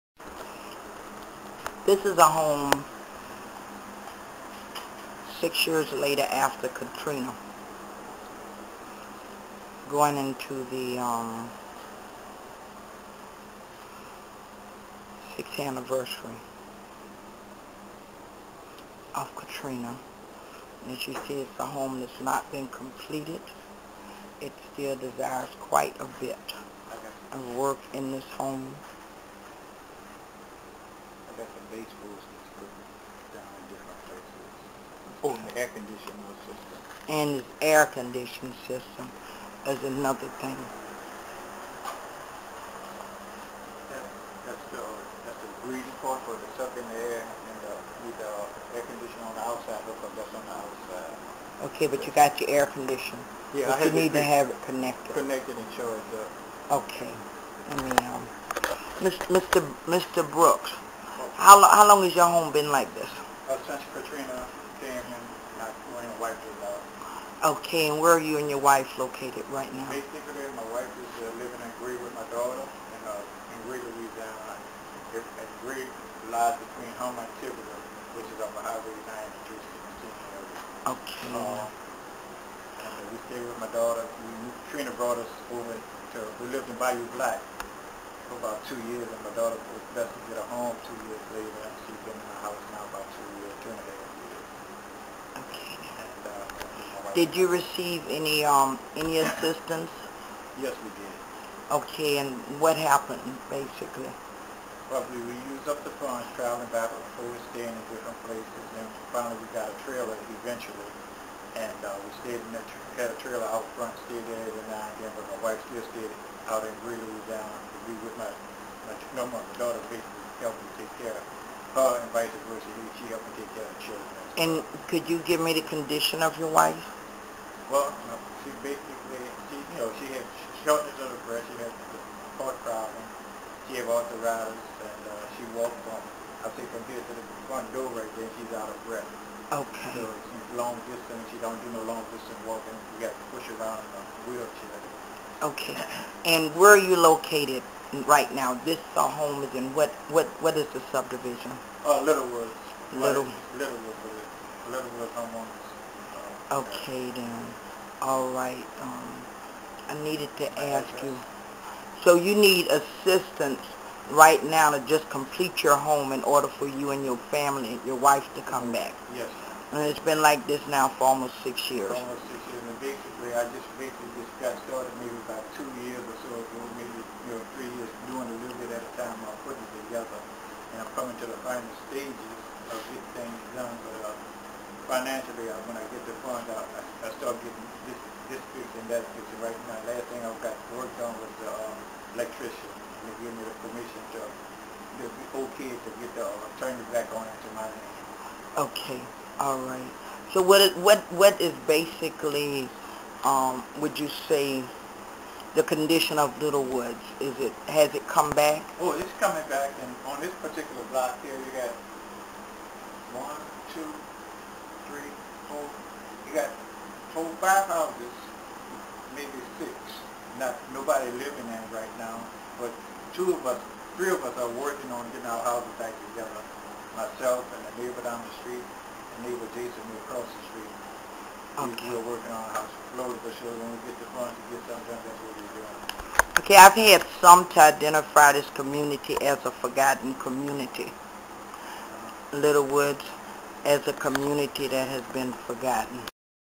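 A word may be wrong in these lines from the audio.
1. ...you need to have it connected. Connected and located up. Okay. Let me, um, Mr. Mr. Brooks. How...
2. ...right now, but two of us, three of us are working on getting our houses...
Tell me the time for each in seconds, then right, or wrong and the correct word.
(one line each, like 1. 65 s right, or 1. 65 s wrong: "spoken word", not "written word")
1. 53 s wrong: "charged", not "located"
2. 221 s right.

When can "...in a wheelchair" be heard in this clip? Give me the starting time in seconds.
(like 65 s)
143 s.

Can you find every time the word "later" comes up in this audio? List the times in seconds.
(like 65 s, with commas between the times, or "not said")
5 s, 91 s.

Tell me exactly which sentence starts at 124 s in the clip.
And could you give me the condition of your wife?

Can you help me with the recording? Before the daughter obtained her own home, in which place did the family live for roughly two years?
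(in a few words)
Bayou Black.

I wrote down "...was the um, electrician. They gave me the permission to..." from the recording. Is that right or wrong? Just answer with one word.
right.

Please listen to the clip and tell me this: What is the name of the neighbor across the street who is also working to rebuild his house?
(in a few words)
Jason.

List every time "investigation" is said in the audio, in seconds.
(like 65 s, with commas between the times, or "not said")
not said.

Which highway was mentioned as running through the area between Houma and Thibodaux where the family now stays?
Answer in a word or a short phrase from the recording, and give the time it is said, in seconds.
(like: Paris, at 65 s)
Highway 93, at 78 s.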